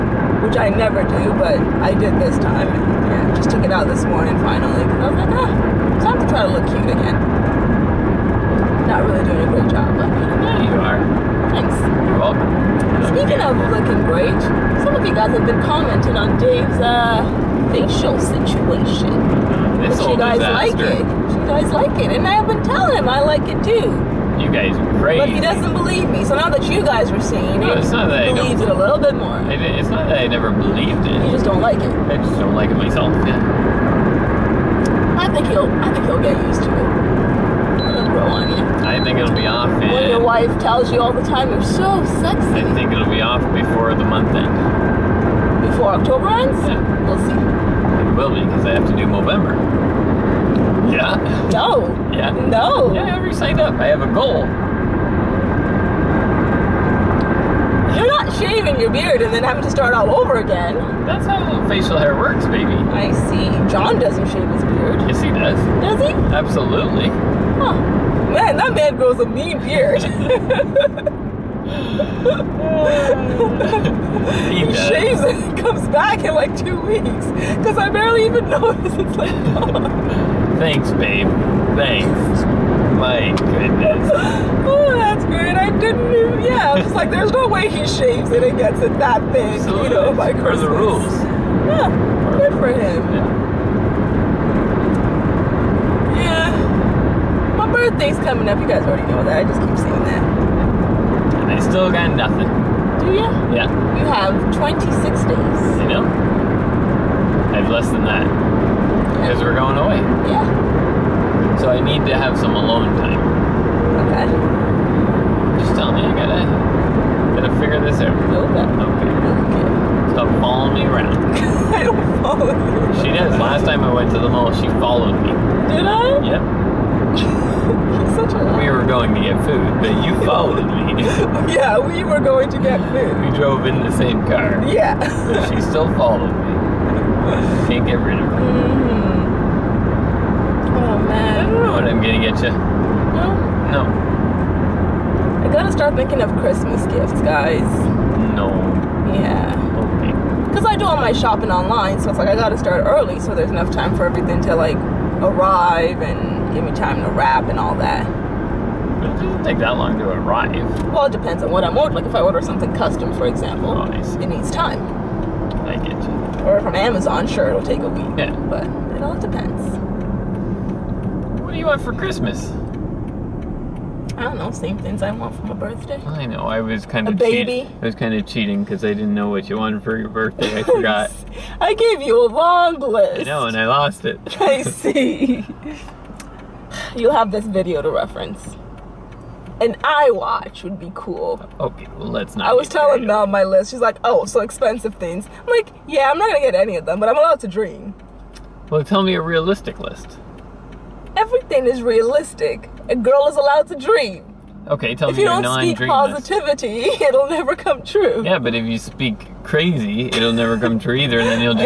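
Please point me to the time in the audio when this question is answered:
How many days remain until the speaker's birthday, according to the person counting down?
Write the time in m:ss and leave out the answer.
1:44.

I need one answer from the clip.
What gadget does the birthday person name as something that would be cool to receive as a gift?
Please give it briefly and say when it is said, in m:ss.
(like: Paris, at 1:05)
iWatch, at 3:09.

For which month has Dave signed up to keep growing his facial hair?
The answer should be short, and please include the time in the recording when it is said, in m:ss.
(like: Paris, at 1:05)
November, at 0:49.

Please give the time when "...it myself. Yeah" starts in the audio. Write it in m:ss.
0:32.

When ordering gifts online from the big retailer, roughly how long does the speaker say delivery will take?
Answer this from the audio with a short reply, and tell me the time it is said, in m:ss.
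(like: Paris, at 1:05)
a week, at 2:47.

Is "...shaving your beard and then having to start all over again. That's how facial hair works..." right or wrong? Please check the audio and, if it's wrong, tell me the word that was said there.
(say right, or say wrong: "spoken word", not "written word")
right.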